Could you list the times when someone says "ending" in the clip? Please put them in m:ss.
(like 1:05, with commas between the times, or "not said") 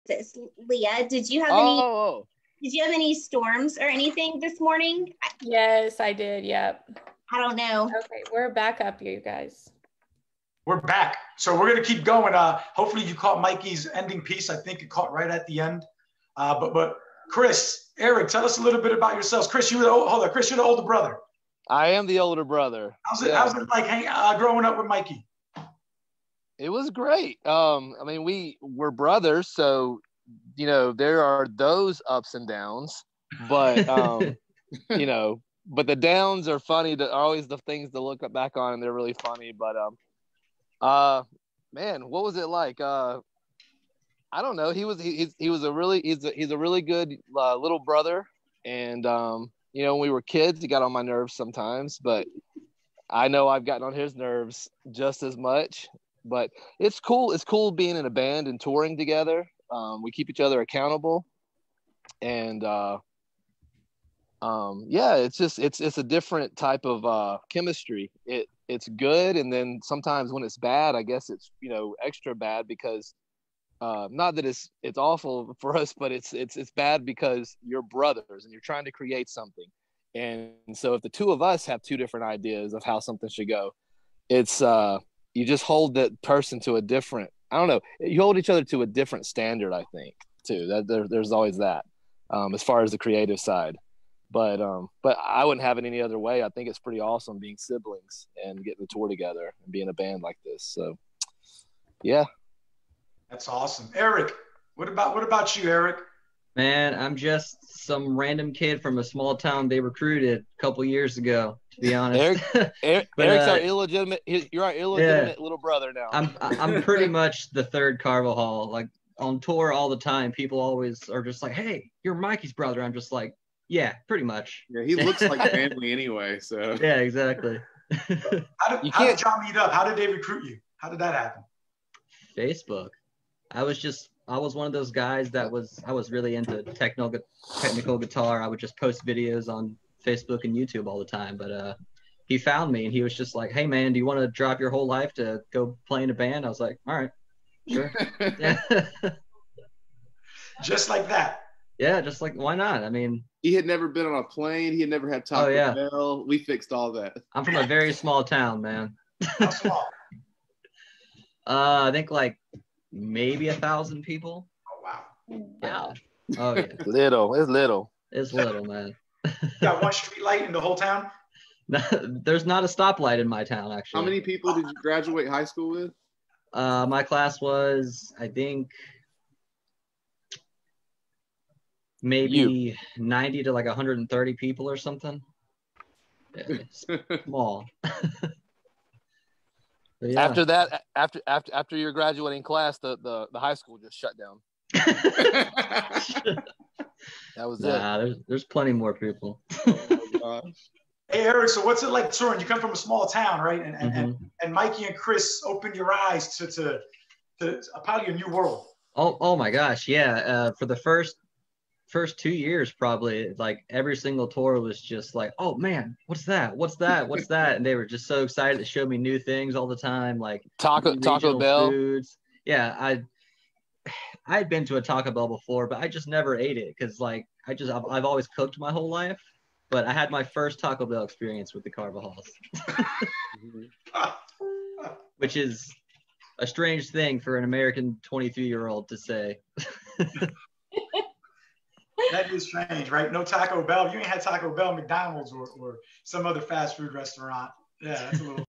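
0:13.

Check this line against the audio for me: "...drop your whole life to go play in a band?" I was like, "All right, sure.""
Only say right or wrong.
right.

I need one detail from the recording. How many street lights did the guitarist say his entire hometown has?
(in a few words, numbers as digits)
1.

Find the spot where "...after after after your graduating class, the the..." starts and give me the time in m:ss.
3:10.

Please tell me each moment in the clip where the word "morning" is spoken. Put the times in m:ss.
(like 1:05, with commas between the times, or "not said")
0:04.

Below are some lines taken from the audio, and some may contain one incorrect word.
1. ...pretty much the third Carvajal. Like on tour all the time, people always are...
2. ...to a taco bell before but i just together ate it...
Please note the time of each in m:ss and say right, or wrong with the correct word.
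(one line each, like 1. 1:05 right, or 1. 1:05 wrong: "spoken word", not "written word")
1. 1:56 right
2. 3:44 wrong: "never", not "together".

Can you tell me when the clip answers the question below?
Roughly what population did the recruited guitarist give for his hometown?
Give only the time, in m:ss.
2:43.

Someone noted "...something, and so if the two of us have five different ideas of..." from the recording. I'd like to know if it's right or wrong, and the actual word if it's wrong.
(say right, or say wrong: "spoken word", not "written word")
wrong: "two", not "five".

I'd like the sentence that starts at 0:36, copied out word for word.
That are always the things to look back on, and they're really funny.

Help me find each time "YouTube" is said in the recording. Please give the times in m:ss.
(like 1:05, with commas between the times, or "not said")
2:20.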